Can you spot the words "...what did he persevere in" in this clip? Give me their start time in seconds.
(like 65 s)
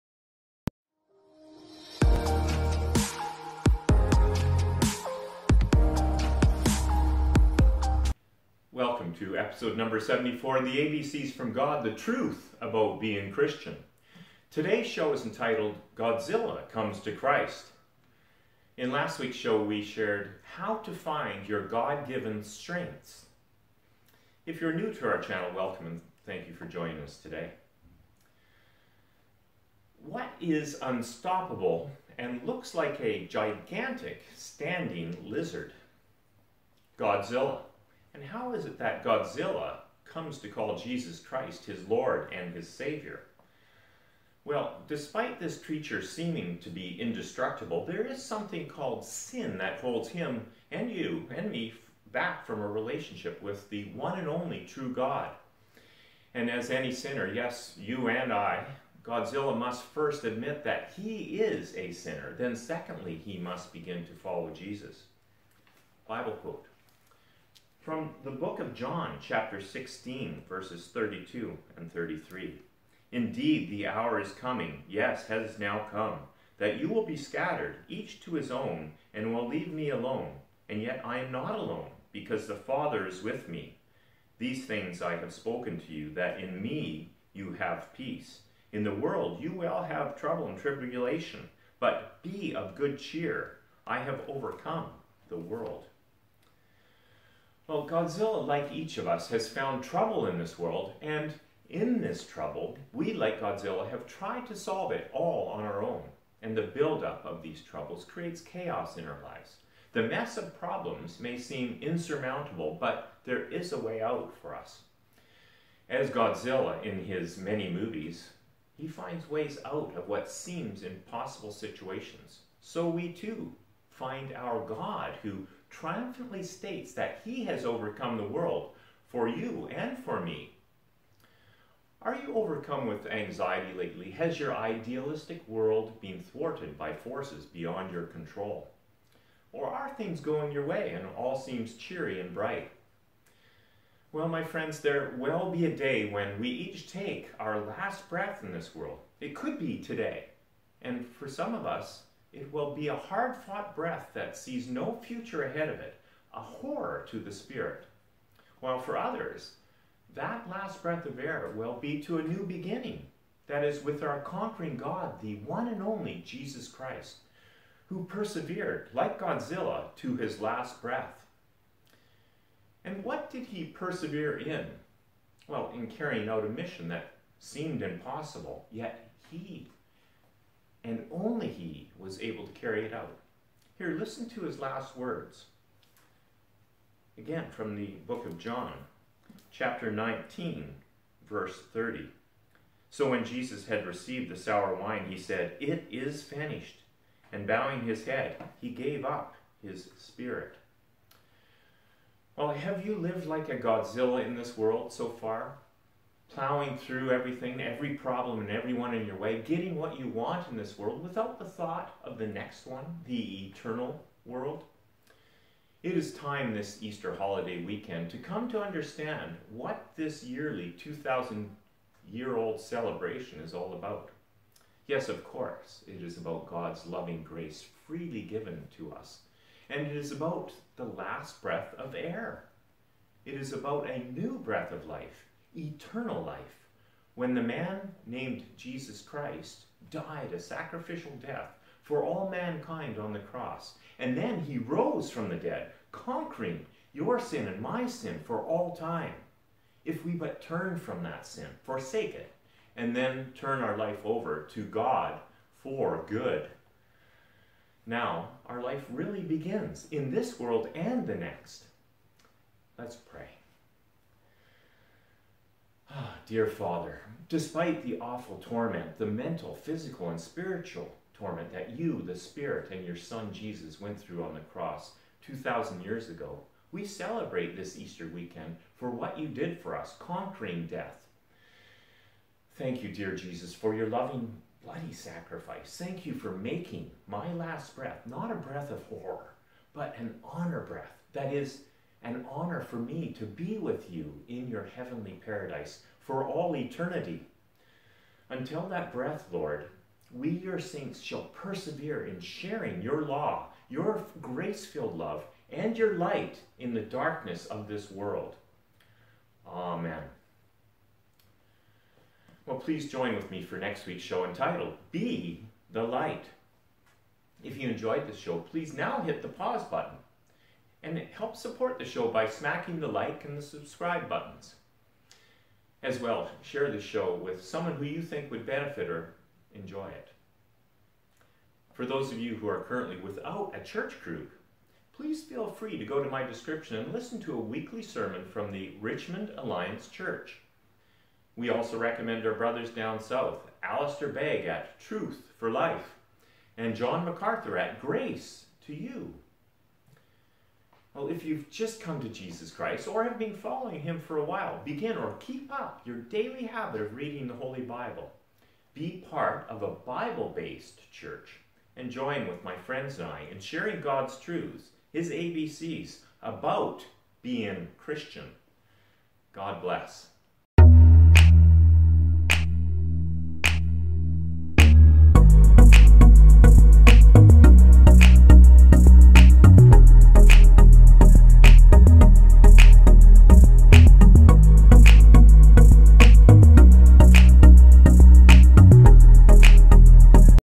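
173 s.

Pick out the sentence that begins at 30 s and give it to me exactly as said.
What is unstoppable and looks like a gigantic standing lizard?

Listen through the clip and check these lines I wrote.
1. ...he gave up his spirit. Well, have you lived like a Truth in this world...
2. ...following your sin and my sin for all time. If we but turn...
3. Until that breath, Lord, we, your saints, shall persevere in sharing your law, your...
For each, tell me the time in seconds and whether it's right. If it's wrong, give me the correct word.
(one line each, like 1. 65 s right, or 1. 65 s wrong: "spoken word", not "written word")
1. 198 s wrong: "Godzilla", not "Truth"
2. 245 s wrong: "conquering", not "following"
3. 298 s right.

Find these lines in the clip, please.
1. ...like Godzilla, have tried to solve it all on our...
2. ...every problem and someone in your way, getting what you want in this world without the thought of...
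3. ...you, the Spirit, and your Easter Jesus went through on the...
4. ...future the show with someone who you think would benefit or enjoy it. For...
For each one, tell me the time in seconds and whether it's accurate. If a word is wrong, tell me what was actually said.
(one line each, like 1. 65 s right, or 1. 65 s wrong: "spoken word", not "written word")
1. 103 s right
2. 207 s wrong: "everyone", not "someone"
3. 271 s wrong: "Son", not "Easter"
4. 326 s wrong: "share", not "future".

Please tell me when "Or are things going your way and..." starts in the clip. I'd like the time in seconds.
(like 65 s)
139 s.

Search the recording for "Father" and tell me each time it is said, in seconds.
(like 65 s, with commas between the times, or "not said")
82 s, 266 s.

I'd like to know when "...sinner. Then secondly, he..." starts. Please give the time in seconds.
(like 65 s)
61 s.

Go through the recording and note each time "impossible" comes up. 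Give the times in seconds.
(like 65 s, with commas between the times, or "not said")
120 s, 177 s.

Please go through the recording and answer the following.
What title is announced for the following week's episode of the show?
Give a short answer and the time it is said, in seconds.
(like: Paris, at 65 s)
Be the Light, at 314 s.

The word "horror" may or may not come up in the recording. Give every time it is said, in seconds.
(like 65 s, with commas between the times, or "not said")
156 s, 288 s.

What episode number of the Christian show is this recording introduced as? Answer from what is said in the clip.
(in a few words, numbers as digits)
74.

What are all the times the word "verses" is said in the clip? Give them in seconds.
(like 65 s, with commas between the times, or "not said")
70 s, 191 s.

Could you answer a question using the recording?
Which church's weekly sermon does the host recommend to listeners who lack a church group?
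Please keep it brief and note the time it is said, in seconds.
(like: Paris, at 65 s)
Richmond Alliance Church, at 338 s.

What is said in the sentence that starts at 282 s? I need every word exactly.
Thank you, dear Jesus, for your loving, bloody sacrifice.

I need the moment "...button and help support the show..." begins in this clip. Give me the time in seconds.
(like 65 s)
319 s.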